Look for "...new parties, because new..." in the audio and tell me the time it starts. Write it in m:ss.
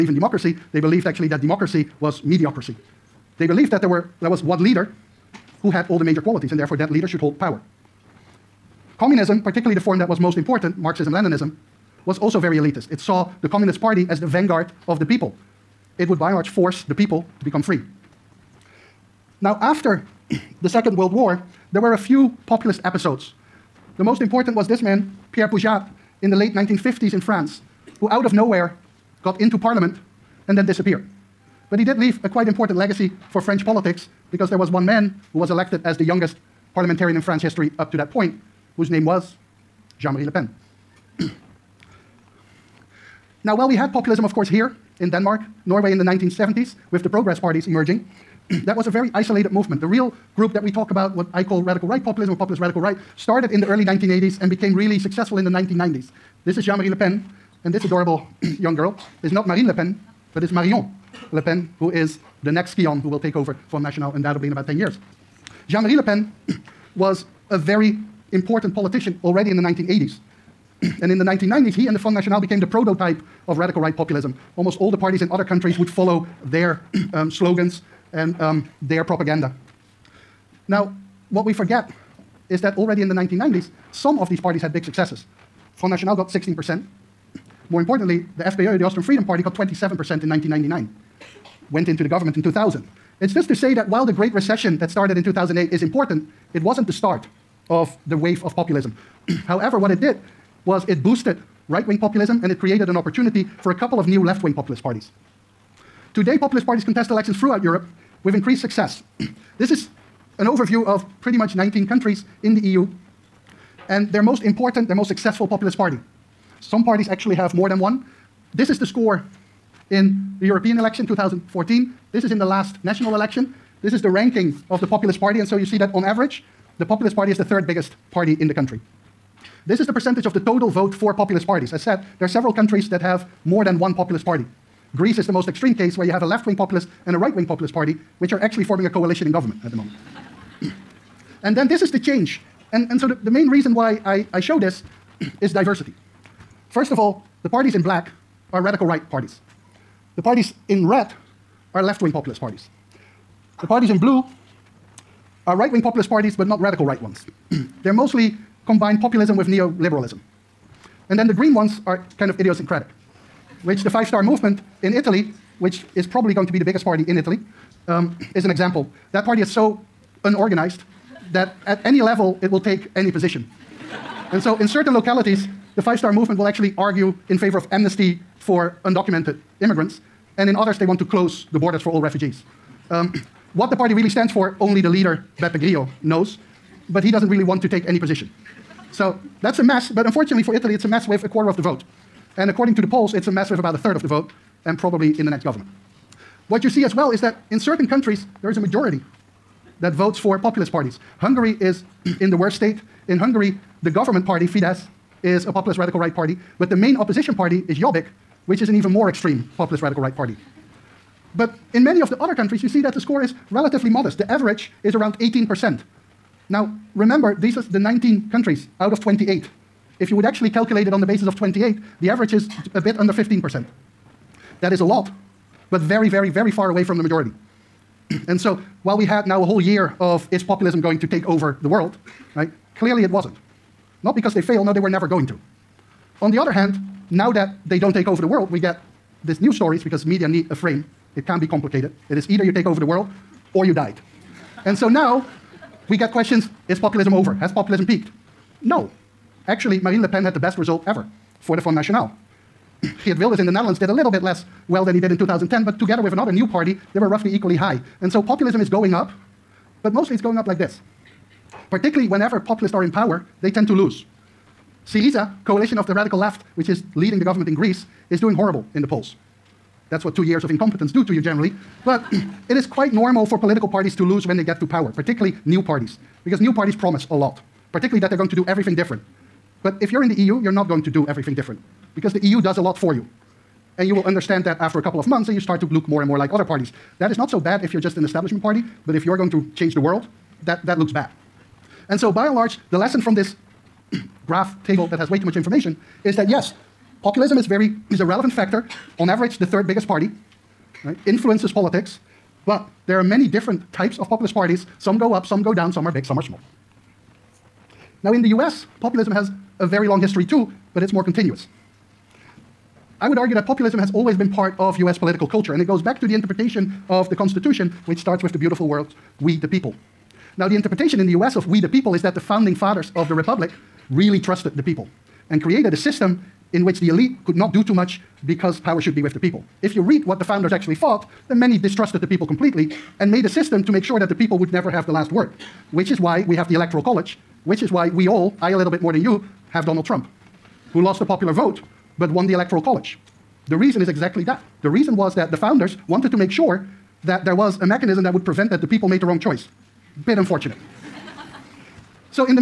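4:35.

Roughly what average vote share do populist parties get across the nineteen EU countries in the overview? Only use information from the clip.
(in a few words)
18%.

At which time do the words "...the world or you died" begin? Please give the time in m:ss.
4:02.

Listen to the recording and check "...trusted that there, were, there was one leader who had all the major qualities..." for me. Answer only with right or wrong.
wrong.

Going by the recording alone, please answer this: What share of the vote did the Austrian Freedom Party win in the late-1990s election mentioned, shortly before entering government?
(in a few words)
27%.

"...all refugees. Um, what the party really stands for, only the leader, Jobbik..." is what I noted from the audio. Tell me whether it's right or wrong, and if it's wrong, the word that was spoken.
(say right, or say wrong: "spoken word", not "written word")
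wrong: "Beppe", not "Jobbik".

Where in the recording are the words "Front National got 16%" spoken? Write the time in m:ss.
1:25.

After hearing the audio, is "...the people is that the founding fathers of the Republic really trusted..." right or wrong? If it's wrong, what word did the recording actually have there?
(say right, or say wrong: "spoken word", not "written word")
right.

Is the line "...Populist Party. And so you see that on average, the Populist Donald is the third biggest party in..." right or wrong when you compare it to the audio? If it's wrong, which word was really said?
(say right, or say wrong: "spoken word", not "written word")
wrong: "Party", not "Donald".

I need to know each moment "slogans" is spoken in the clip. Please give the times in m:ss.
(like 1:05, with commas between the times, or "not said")
1:17.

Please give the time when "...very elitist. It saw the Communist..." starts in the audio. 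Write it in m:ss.
0:12.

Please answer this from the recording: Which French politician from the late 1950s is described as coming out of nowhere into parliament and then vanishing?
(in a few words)
Pierre Poujat.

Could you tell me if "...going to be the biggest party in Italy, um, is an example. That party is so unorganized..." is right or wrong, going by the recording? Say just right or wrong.
right.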